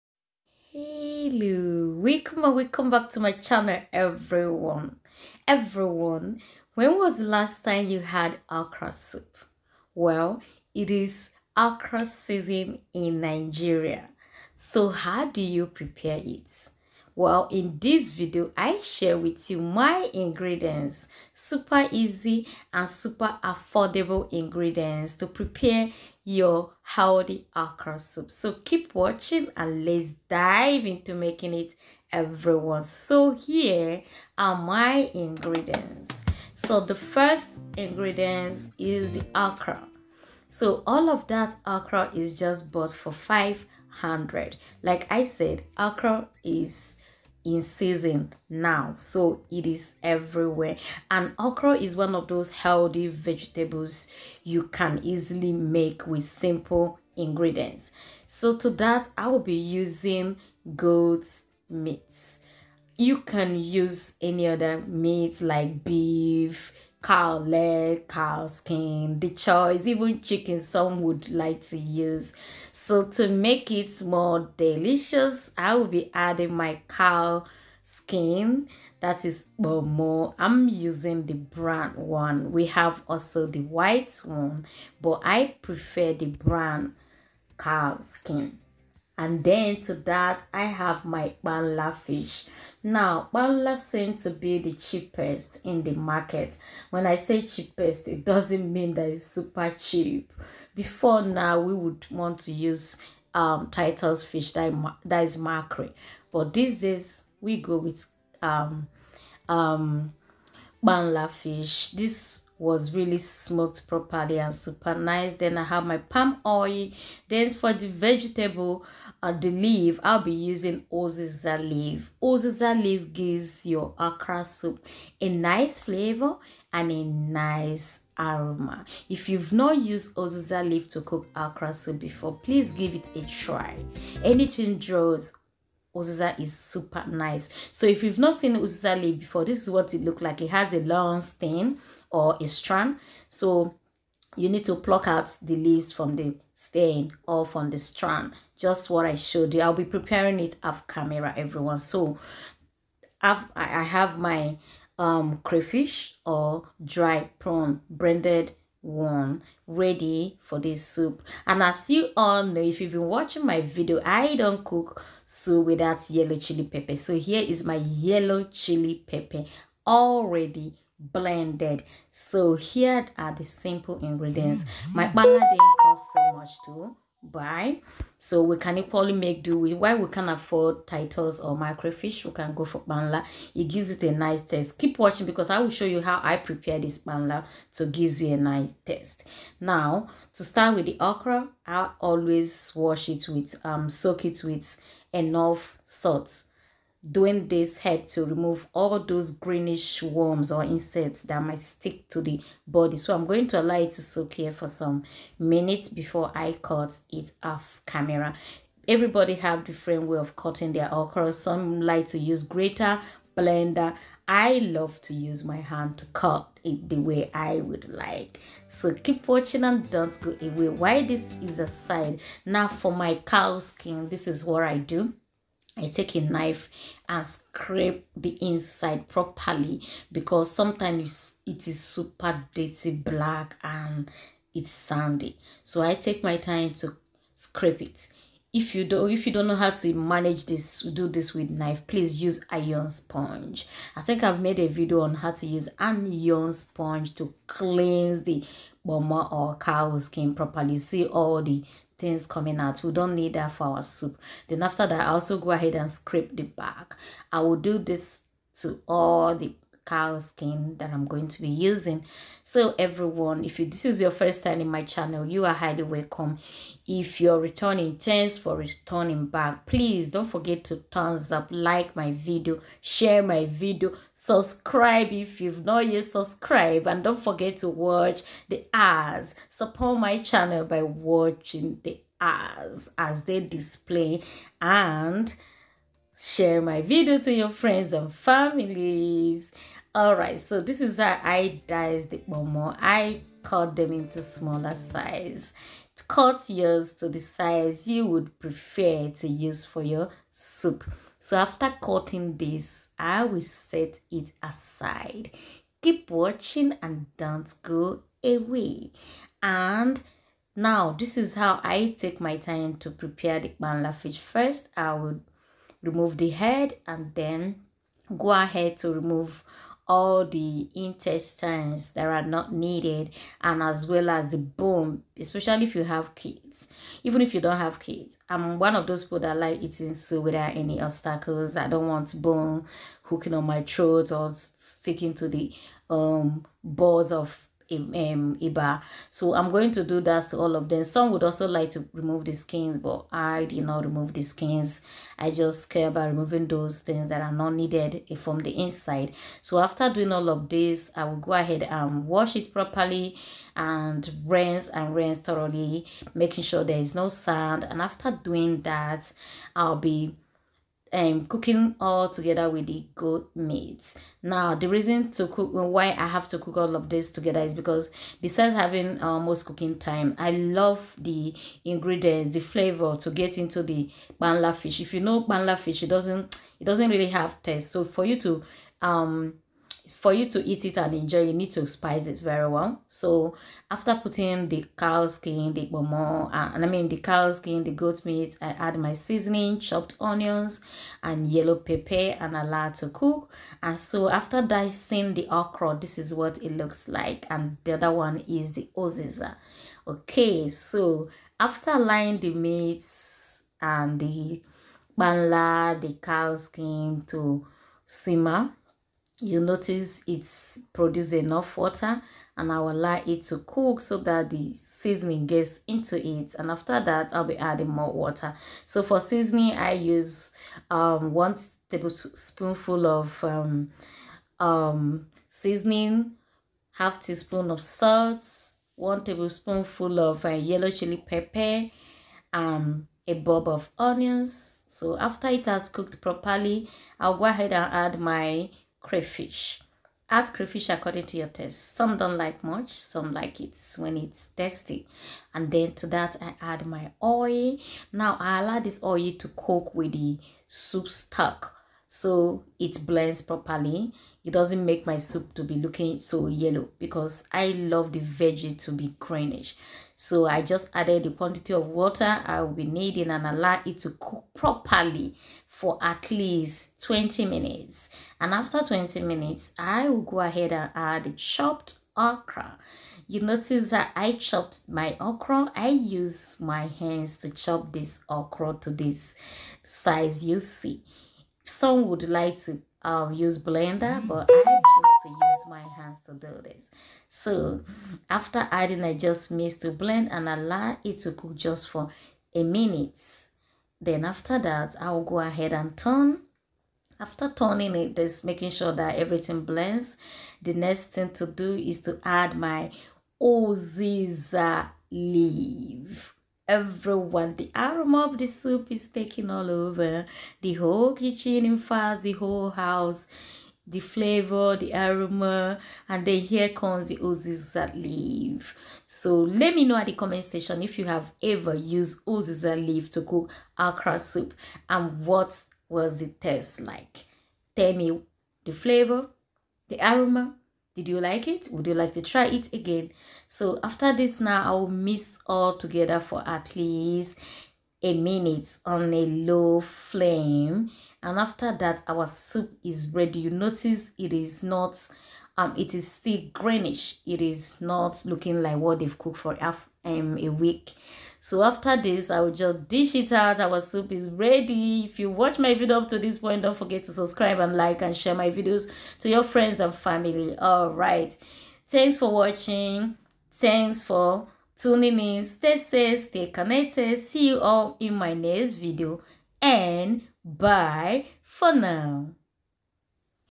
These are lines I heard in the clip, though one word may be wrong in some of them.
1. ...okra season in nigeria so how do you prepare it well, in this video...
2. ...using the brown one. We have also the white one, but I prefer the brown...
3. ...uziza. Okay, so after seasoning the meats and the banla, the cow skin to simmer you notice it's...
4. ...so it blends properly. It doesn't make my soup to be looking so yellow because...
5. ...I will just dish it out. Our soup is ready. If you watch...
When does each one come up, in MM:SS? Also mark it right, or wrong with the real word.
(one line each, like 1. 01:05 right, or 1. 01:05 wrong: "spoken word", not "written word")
1. 00:11 right
2. 01:20 right
3. 06:38 wrong: "laying", not "seasoning"
4. 07:31 right
5. 09:12 right.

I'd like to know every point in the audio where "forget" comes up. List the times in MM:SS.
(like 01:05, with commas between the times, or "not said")
04:30, 04:37, 09:16.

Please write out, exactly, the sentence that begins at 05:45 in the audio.
I just care about removing those things that are not needed eh, from the inside.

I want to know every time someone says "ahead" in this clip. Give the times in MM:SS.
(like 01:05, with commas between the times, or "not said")
04:15, 05:18, 05:51, 07:17, 07:50, 08:15.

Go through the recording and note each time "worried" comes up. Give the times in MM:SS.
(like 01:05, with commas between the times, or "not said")
not said.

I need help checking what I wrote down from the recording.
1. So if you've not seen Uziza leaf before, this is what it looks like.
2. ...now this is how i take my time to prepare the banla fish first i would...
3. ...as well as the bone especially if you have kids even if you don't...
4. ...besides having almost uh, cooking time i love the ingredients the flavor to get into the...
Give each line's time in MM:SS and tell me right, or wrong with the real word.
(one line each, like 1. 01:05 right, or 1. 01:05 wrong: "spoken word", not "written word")
1. 02:17 right
2. 05:10 right
3. 05:23 right
4. 06:08 right.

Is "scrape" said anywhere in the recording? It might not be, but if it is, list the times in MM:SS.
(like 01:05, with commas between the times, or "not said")
03:47, 03:57, 04:15.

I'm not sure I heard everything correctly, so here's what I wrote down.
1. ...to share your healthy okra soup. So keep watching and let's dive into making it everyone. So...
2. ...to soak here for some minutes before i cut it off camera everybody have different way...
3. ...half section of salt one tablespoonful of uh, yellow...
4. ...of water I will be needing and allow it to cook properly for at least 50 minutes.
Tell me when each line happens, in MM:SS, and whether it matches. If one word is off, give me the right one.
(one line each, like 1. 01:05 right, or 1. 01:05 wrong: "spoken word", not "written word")
1. 00:25 wrong: "prepare", not "share"
2. 03:23 right
3. 07:06 wrong: "teaspoon", not "section"
4. 07:41 wrong: "20", not "50".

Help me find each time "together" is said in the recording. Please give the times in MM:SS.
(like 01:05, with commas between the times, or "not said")
06:02, 06:07, 08:55.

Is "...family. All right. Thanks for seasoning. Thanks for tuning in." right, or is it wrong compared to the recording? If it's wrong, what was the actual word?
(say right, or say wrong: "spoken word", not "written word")
wrong: "watching", not "seasoning".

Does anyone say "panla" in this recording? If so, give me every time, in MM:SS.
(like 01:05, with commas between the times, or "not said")
03:02, 03:06.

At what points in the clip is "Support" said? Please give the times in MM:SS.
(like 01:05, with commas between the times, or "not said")
04:39.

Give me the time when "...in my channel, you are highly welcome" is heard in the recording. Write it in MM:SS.
04:24.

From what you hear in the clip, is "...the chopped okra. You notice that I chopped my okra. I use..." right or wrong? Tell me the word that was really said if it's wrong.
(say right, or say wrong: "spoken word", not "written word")
right.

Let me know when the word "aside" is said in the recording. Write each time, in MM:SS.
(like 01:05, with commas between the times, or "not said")
03:41, 05:04.